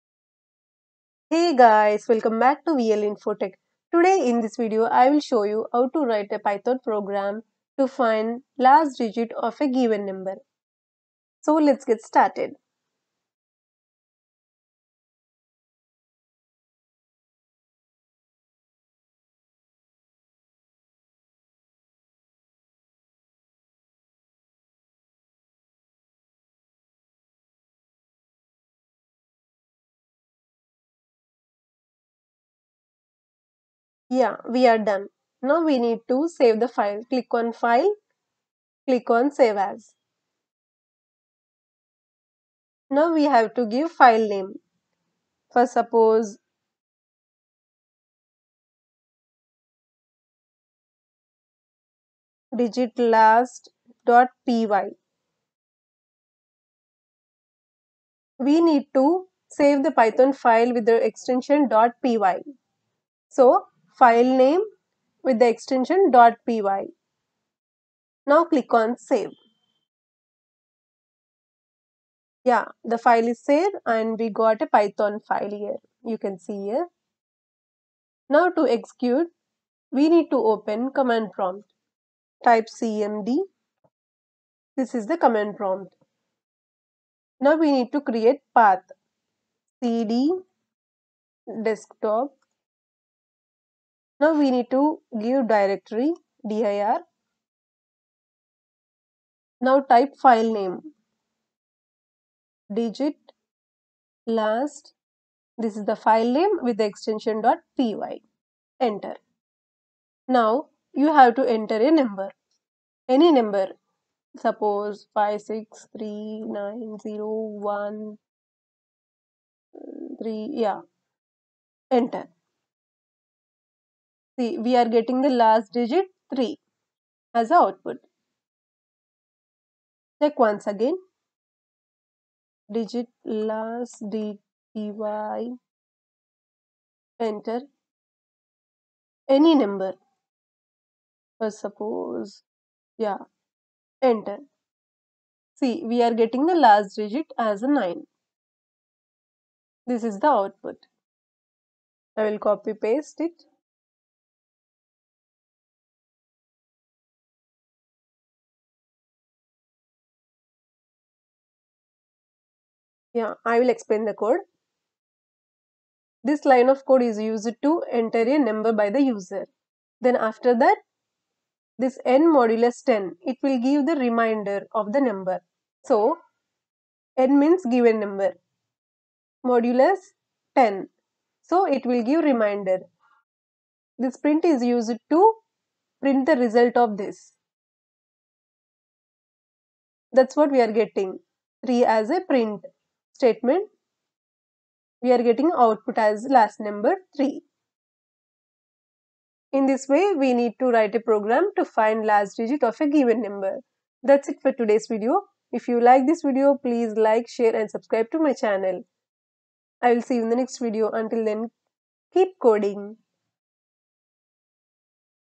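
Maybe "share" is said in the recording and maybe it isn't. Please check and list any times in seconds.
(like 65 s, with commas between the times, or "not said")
207 s.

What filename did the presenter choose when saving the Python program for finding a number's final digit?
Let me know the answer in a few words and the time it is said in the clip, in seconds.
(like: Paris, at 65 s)
digit_last.py, at 52 s.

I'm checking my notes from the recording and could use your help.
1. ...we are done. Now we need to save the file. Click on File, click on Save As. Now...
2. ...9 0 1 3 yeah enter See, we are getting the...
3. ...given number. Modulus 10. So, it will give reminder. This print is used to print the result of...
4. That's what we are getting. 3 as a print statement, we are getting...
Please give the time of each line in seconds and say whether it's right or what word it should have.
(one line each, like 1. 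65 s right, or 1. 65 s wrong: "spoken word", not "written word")
1. 34 s right
2. 116 s right
3. 177 s right
4. 190 s right.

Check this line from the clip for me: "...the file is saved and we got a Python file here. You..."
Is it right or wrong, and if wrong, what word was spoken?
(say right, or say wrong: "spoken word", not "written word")
right.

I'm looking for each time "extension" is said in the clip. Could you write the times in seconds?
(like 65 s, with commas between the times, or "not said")
61 s, 65 s, 106 s.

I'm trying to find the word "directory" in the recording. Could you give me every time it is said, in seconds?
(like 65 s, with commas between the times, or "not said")
95 s.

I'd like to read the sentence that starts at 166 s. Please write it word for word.
This line of code is used to enter a number by the user.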